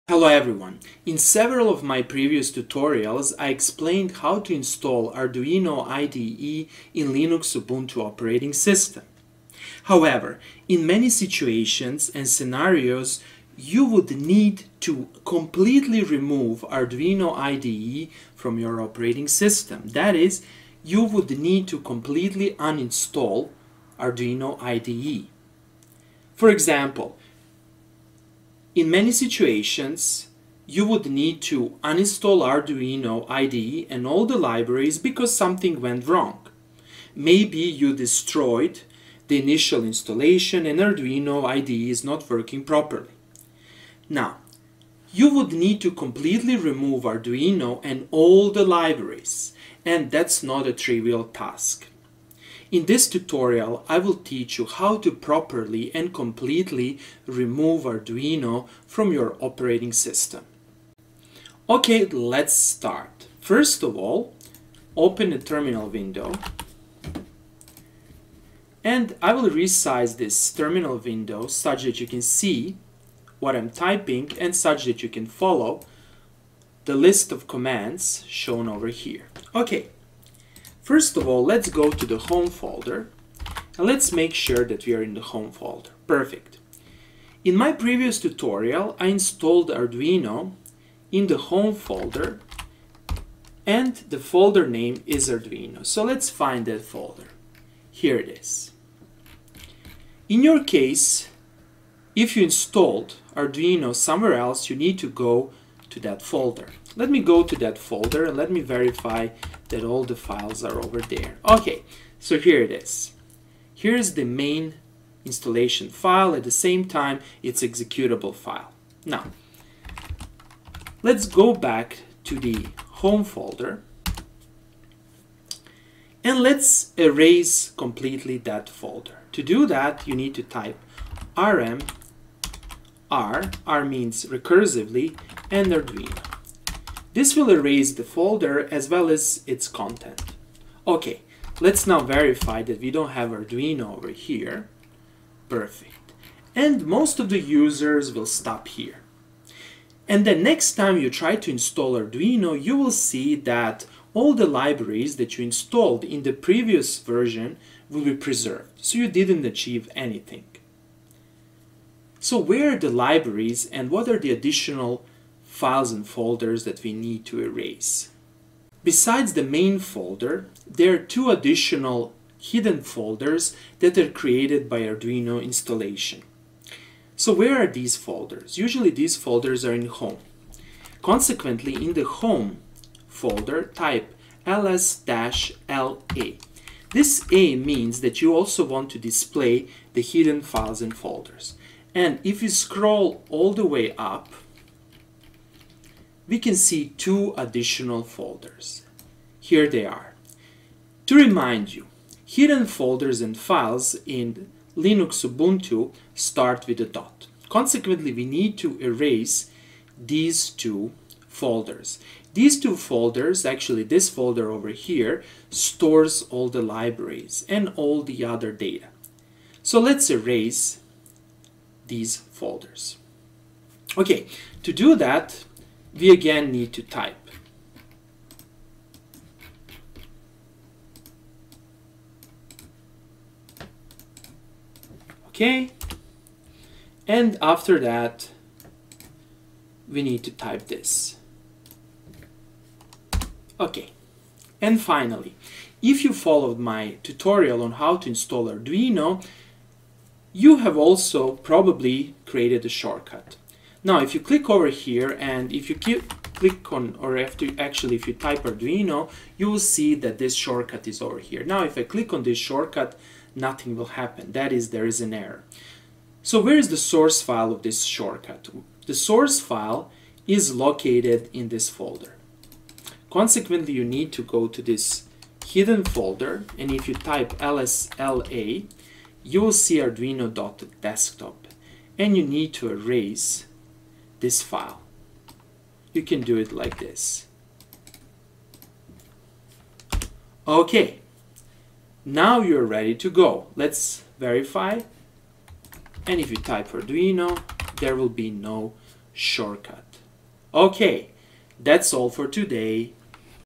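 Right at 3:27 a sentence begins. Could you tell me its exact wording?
Consequently, we need to erase these two folders.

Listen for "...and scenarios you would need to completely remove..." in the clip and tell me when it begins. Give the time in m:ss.
0:12.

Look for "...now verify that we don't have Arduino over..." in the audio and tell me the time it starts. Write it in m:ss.
2:21.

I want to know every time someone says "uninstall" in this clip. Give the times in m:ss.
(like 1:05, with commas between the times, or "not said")
0:22, 0:31.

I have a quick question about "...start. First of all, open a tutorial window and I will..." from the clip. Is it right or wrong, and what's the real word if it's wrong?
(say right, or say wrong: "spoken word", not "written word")
wrong: "terminal", not "tutorial".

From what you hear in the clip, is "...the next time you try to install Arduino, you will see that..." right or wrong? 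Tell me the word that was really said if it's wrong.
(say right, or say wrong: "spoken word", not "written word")
right.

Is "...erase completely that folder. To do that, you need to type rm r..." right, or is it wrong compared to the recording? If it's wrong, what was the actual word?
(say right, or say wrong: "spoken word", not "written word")
right.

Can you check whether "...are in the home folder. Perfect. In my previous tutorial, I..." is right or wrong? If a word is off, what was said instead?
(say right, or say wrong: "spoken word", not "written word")
right.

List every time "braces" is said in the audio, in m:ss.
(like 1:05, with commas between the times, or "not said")
not said.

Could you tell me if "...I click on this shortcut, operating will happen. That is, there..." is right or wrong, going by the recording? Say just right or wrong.
wrong.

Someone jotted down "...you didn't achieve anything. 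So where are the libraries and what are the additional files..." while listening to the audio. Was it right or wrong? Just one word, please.
right.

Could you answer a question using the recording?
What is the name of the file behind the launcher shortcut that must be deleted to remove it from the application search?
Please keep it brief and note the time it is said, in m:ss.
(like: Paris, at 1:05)
arduino.desktop, at 4:39.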